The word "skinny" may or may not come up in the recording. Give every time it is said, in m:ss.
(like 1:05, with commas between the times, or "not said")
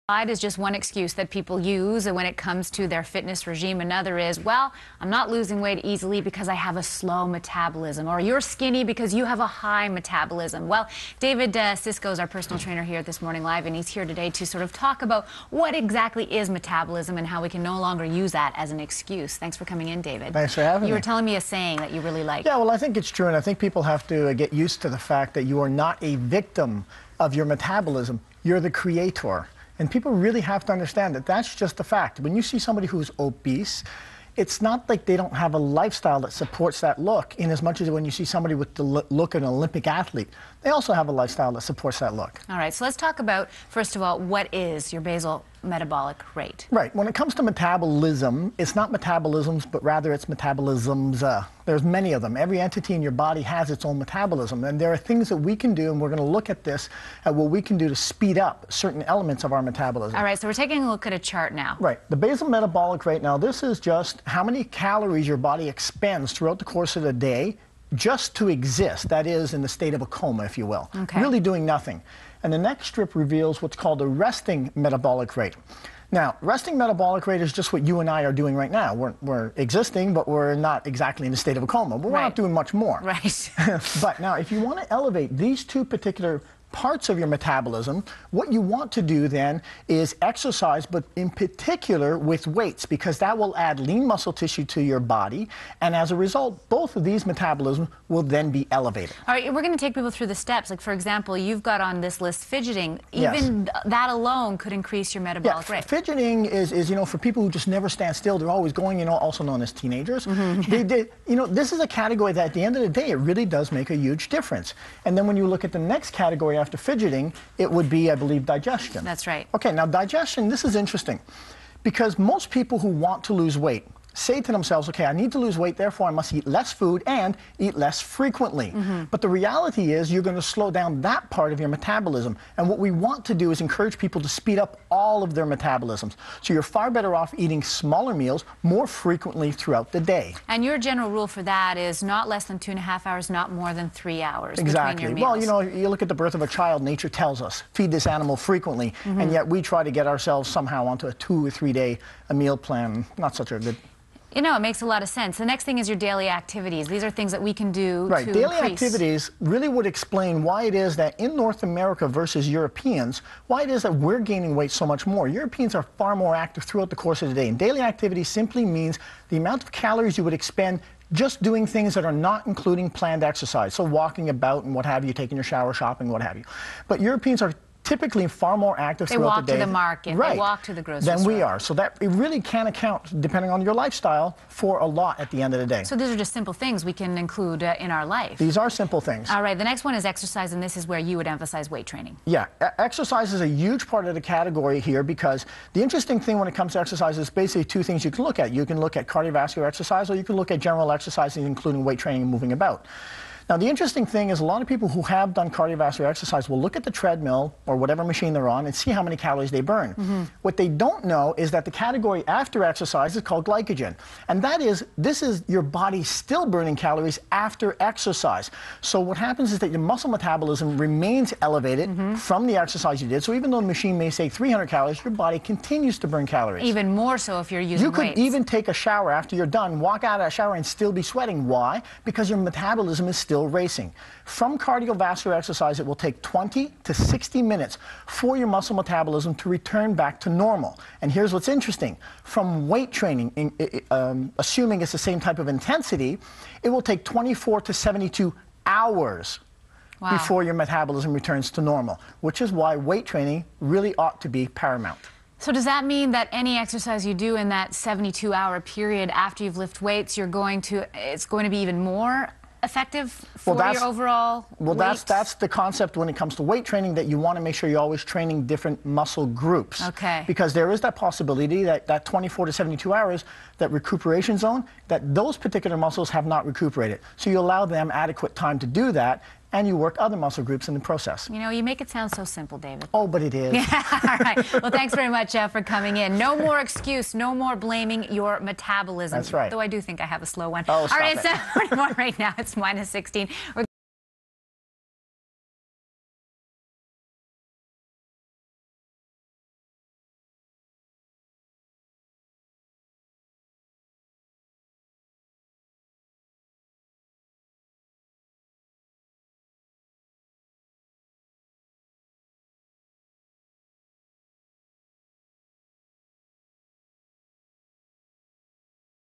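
0:08.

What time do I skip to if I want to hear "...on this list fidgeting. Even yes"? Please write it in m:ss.
1:41.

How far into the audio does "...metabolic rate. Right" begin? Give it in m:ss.
0:45.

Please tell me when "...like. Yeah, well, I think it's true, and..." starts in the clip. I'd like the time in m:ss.
0:22.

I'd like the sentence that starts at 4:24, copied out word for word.
that's, that's the concept when it comes to weight training that you want to make sure you're always training different muscle groups.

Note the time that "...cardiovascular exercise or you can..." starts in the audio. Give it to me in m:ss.
3:19.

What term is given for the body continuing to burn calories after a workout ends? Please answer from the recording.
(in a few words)
glycogen.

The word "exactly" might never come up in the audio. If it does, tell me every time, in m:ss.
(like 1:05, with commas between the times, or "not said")
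0:15, 1:20, 2:24.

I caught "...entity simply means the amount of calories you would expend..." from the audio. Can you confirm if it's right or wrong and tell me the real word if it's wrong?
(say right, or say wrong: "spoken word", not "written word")
wrong: "activity", not "entity".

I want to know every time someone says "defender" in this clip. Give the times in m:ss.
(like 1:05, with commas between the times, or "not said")
not said.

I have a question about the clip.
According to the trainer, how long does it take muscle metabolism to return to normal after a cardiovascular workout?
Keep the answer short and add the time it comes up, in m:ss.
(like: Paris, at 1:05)
20 to 60 minutes, at 3:56.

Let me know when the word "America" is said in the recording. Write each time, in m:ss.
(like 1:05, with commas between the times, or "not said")
2:41.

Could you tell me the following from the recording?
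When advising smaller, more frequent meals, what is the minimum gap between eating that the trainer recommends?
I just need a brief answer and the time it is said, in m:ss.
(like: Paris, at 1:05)
2 and a half hours, at 2:22.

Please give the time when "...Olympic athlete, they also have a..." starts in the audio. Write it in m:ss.
0:39.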